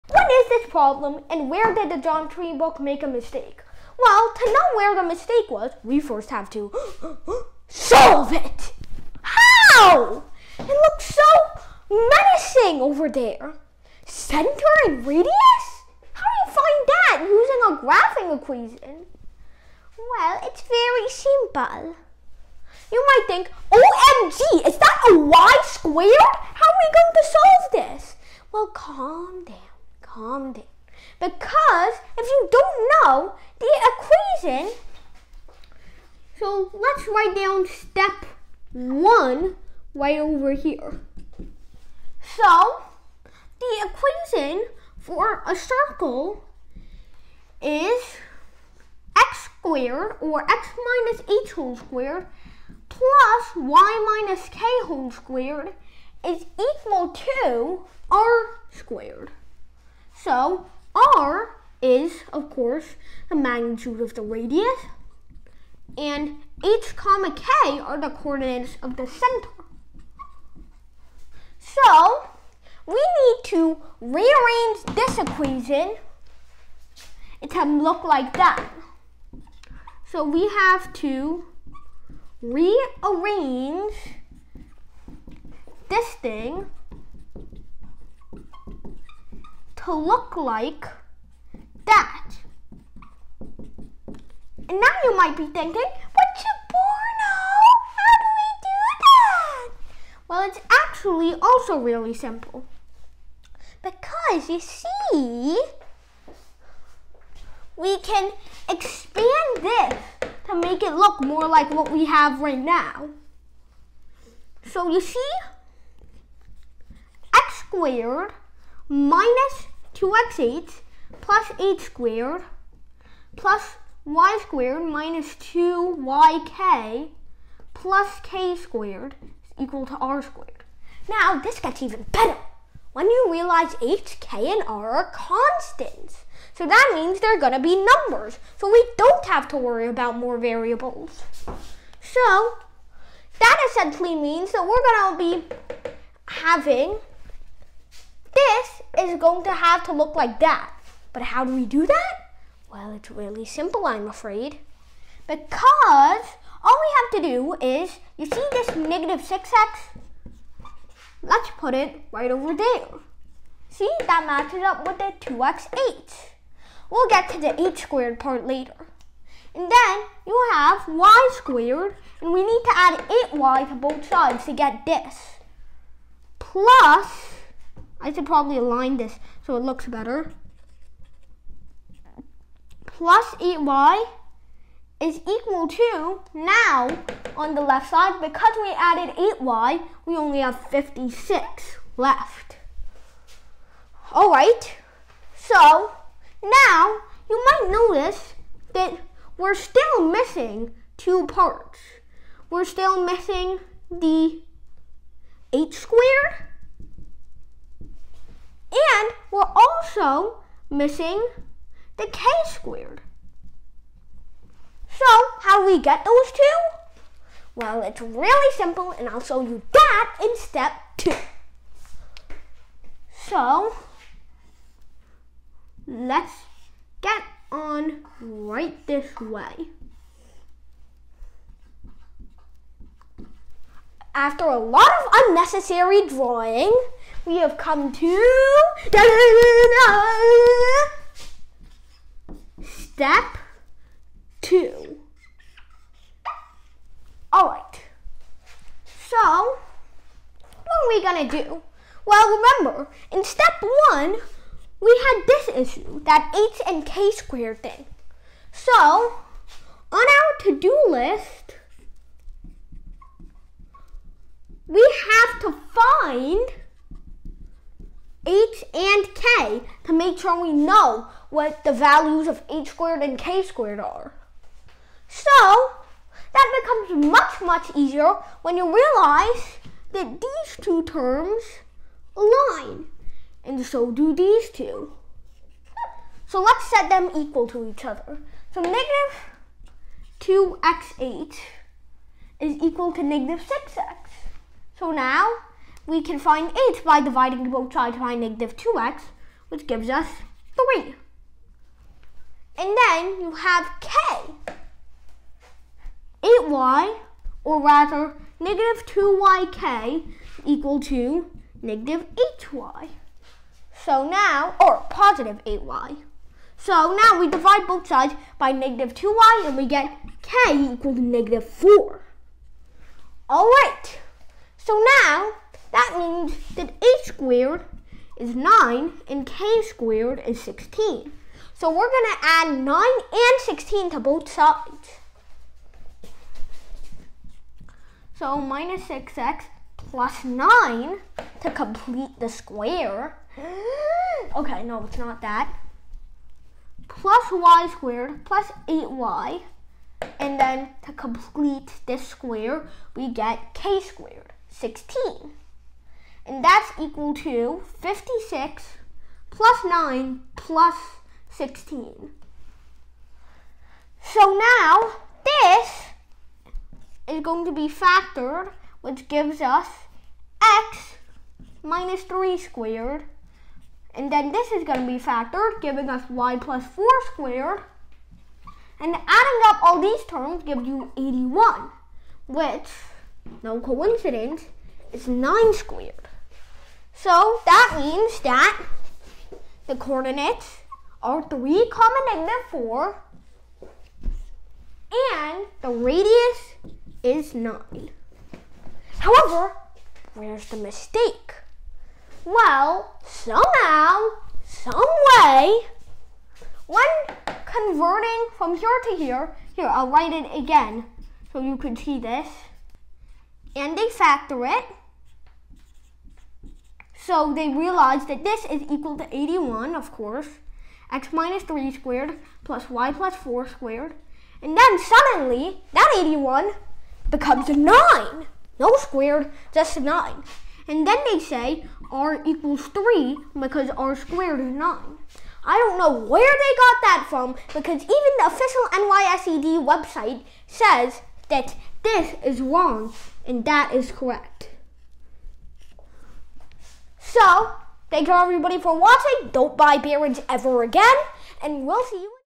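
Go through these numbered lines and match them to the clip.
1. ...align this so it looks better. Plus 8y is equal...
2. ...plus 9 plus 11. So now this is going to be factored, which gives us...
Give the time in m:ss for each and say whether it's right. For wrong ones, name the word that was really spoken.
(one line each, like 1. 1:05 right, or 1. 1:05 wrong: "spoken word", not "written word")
1. 2:58 right
2. 5:59 wrong: "16", not "11".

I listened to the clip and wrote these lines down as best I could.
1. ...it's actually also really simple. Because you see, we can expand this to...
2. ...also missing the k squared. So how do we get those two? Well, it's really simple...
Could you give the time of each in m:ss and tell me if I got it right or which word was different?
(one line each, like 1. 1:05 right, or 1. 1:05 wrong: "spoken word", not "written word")
1. 1:40 right
2. 3:29 right.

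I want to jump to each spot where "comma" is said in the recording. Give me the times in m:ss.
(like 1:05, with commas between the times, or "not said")
1:06, 6:31.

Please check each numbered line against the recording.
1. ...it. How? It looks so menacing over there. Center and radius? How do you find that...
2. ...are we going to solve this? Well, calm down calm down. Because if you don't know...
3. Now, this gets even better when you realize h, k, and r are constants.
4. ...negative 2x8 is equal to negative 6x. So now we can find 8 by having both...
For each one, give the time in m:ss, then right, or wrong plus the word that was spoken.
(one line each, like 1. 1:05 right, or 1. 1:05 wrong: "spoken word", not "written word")
1. 0:08 right
2. 0:26 right
3. 2:11 right
4. 4:48 wrong: "dividing", not "having".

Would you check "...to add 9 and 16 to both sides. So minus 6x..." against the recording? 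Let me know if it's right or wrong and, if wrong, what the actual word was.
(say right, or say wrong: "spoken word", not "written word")
right.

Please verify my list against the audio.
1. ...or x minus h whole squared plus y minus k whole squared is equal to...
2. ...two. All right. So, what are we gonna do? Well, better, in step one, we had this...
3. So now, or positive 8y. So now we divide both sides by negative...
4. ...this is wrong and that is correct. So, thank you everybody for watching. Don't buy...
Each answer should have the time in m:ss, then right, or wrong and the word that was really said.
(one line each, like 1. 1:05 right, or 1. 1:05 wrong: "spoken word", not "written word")
1. 0:50 right
2. 4:04 wrong: "remember", not "better"
3. 5:13 right
4. 7:21 right.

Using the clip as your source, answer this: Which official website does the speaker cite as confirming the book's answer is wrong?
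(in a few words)
NYSED.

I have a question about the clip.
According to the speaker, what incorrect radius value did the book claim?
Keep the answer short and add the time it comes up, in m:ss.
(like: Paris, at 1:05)
3, at 7:11.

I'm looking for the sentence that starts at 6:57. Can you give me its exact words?
So they realized that this is equal to 81, of course, x minus 3 squared plus y plus 4 squared.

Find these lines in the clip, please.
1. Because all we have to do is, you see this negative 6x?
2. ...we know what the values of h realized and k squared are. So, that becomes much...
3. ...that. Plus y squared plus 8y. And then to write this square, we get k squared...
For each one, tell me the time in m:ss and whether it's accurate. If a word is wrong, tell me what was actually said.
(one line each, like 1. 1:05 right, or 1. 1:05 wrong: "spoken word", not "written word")
1. 2:35 right
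2. 4:30 wrong: "squared", not "realized"
3. 5:45 wrong: "complete", not "write".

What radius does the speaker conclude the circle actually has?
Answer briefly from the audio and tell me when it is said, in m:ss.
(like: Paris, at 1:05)
9, at 6:35.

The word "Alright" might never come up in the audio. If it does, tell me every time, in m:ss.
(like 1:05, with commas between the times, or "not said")
3:14, 5:23.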